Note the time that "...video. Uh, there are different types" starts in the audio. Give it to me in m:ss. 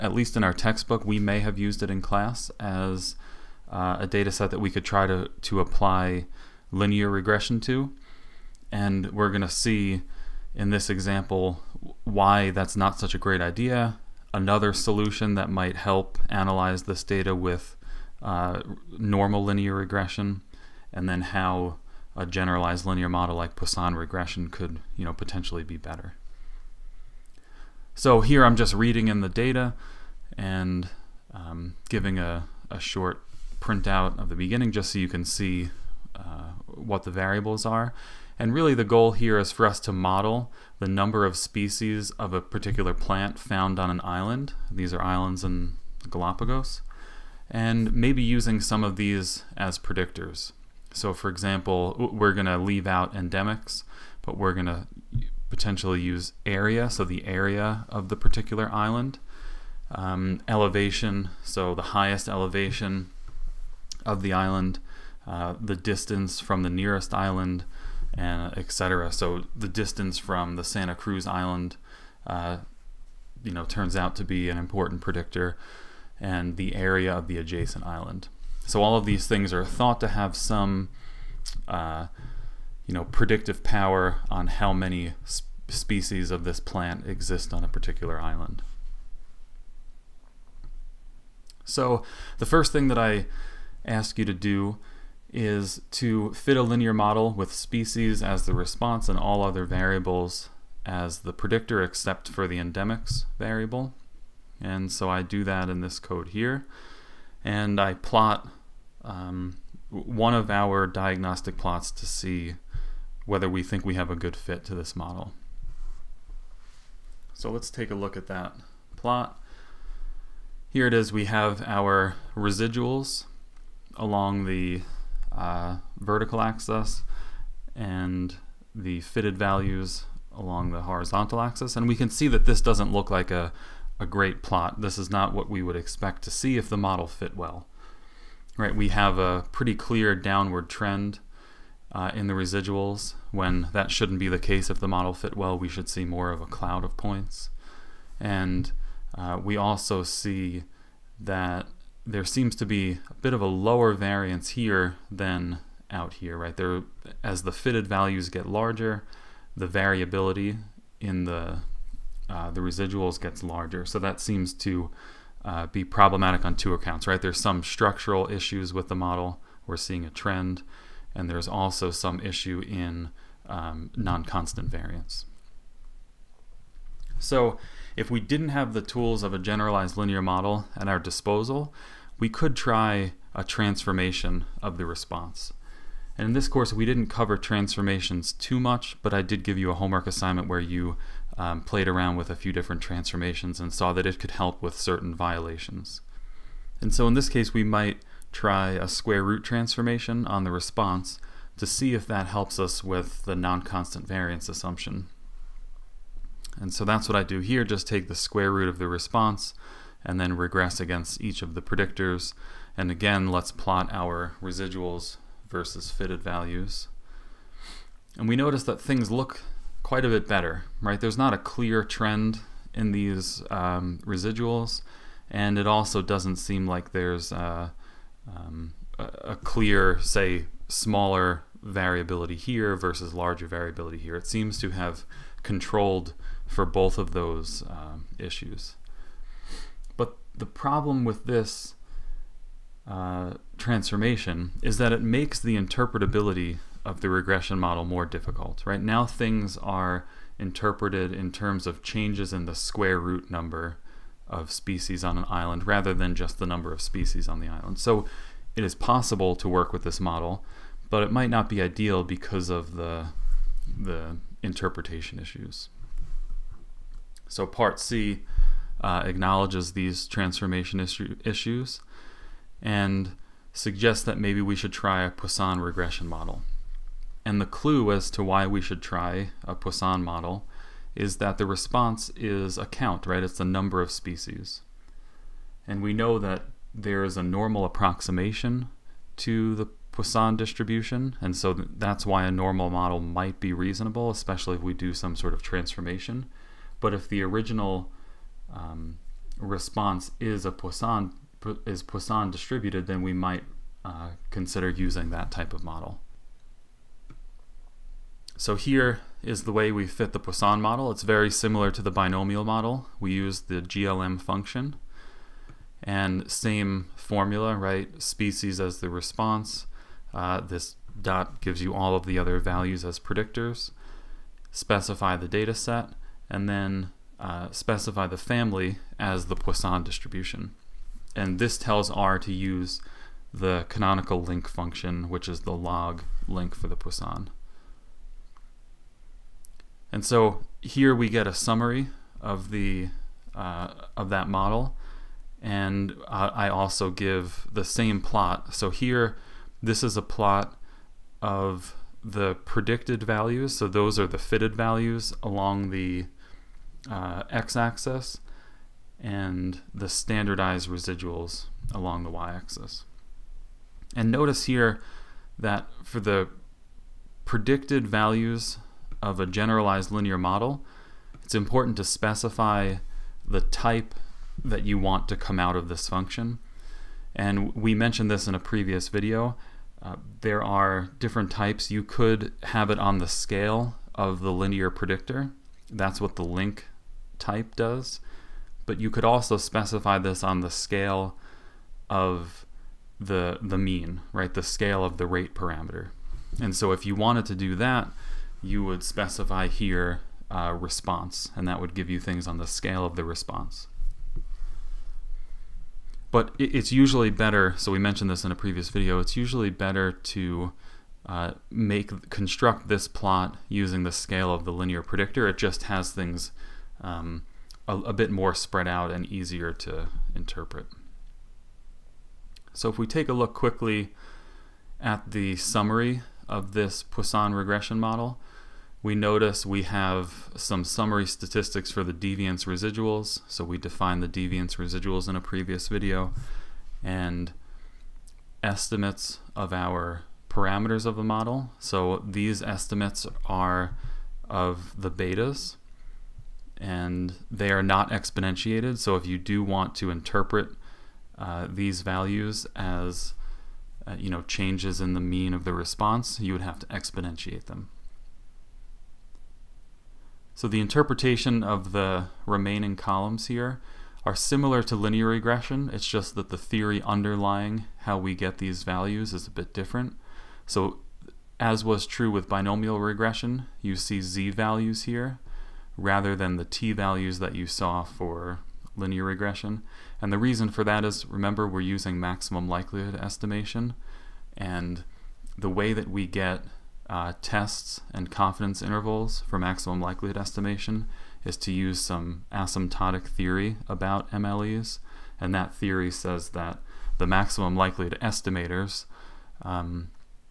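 6:18.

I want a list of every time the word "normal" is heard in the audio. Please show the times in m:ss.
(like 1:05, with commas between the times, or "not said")
0:18, 4:47, 4:52.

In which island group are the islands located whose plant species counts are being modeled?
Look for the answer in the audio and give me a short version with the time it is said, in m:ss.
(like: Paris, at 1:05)
Galapagos, at 0:46.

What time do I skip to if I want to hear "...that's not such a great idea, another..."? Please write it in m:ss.
0:12.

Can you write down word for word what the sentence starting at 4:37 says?
And the clue as to why we should try a Poisson model is that the response is a count, right?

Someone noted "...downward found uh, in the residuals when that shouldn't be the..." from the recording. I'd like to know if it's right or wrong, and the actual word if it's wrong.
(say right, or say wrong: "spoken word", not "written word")
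wrong: "trend", not "found".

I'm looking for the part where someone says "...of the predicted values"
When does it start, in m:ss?
5:51.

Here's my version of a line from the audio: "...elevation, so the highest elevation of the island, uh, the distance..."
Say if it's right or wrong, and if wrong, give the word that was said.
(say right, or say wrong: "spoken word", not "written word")
right.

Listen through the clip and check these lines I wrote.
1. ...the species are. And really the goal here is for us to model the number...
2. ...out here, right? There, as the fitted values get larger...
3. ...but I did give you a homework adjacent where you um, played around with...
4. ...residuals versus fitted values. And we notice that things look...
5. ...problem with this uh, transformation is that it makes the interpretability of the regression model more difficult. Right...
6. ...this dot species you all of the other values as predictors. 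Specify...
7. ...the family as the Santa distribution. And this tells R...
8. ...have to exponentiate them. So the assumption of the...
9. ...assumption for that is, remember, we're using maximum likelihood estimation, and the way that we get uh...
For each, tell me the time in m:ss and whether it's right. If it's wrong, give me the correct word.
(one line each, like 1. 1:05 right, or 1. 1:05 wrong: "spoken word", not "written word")
1. 0:37 wrong: "variables", not "species"
2. 2:35 right
3. 3:09 wrong: "assignment", not "adjacent"
4. 3:34 right
5. 4:00 right
6. 5:20 wrong: "gives", not "species"
7. 5:28 wrong: "Poisson", not "Santa"
8. 7:36 wrong: "interpretation", not "assumption"
9. 8:00 wrong: "reason", not "assumption".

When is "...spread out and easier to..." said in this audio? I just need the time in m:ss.
6:58.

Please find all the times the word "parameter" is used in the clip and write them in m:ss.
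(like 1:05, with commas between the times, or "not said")
6:35, 7:20.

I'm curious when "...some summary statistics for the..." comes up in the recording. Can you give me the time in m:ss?
7:10.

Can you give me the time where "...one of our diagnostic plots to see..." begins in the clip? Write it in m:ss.
1:49.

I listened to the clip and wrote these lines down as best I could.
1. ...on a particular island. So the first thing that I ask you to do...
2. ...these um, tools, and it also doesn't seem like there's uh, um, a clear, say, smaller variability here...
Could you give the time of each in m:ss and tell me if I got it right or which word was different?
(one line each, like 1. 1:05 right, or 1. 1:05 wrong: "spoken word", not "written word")
1. 1:27 right
2. 3:42 wrong: "residuals", not "tools".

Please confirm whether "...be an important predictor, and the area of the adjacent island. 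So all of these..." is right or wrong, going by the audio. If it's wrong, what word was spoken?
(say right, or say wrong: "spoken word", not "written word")
right.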